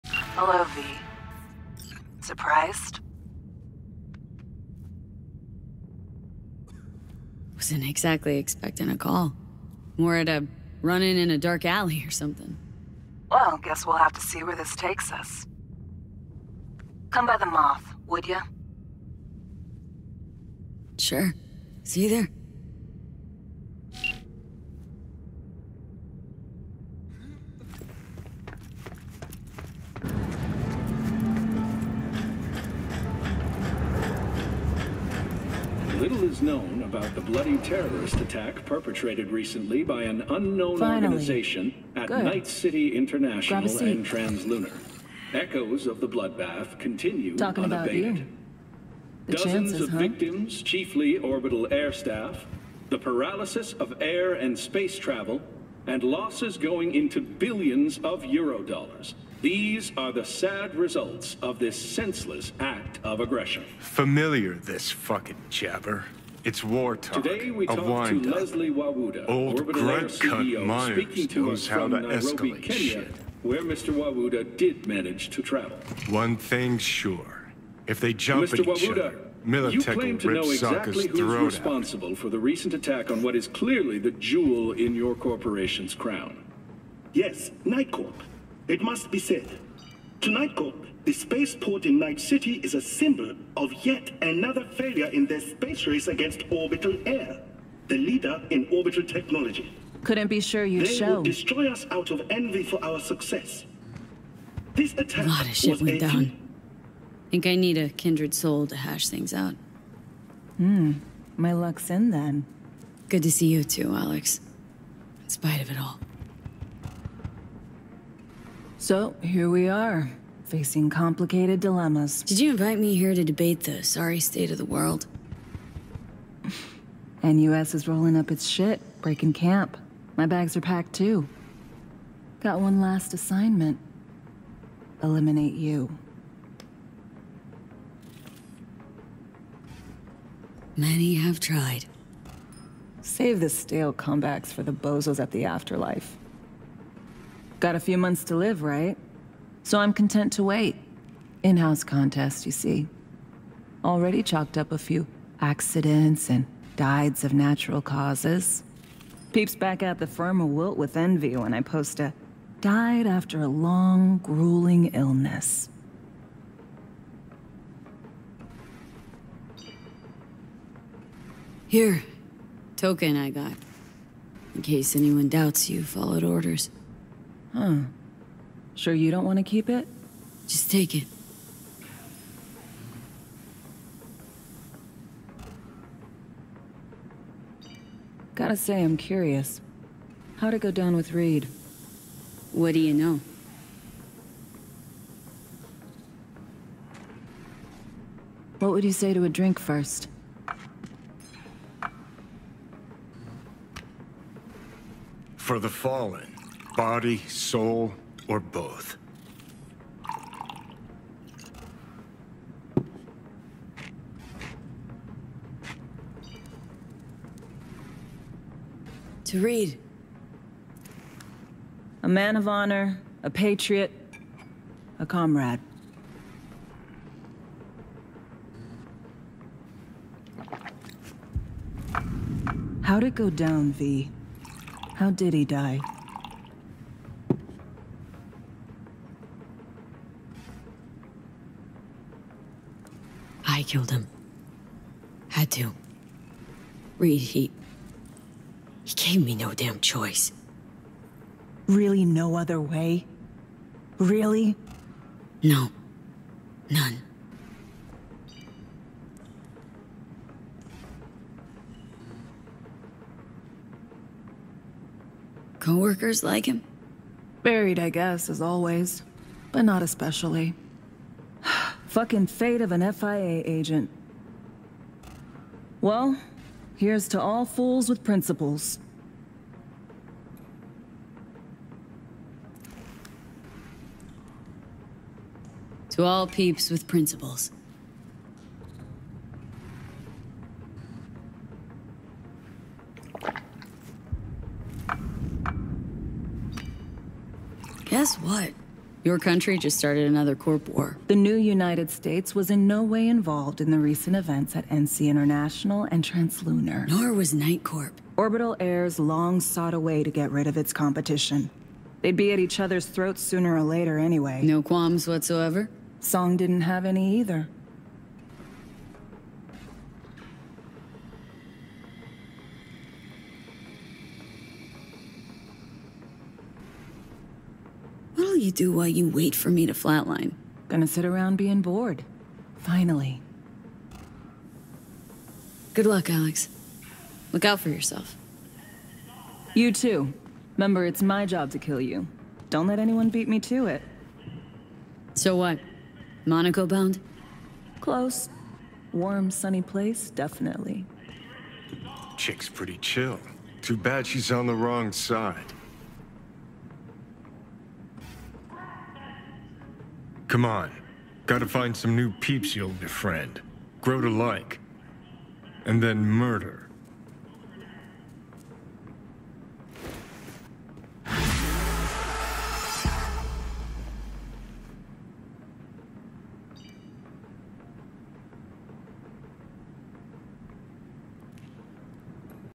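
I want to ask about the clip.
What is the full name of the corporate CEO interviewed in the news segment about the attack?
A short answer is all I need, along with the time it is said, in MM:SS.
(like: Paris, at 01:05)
Leslie Wawuda, at 01:08.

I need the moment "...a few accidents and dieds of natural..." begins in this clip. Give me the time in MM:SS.
02:34.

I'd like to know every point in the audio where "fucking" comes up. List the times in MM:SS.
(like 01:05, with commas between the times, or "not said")
01:04, 04:31.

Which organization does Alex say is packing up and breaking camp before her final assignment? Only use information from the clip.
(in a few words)
NUS.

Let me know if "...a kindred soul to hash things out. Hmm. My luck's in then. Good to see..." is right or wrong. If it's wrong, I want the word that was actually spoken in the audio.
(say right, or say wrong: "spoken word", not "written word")
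right.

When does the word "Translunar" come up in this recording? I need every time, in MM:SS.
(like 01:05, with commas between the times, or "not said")
00:44, 05:06.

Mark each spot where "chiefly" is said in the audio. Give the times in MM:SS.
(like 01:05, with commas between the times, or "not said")
00:50.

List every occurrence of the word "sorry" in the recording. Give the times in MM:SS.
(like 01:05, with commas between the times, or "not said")
02:03.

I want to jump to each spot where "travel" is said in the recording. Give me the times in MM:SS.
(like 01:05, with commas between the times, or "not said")
00:54, 01:15.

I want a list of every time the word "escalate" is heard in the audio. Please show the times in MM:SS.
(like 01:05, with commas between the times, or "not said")
01:12.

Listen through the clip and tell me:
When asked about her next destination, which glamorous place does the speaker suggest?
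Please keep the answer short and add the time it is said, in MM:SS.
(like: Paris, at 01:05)
Monaco, at 05:46.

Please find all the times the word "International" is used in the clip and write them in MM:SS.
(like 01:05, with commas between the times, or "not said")
00:42, 05:05.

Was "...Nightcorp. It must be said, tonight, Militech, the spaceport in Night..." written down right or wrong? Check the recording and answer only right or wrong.
wrong.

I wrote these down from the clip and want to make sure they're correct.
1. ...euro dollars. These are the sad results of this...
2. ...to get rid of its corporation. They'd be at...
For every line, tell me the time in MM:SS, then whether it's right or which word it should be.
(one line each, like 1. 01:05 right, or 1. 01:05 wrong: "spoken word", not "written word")
1. 00:58 right
2. 05:10 wrong: "competition", not "corporation".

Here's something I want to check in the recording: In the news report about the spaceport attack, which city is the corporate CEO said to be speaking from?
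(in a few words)
Nairobi.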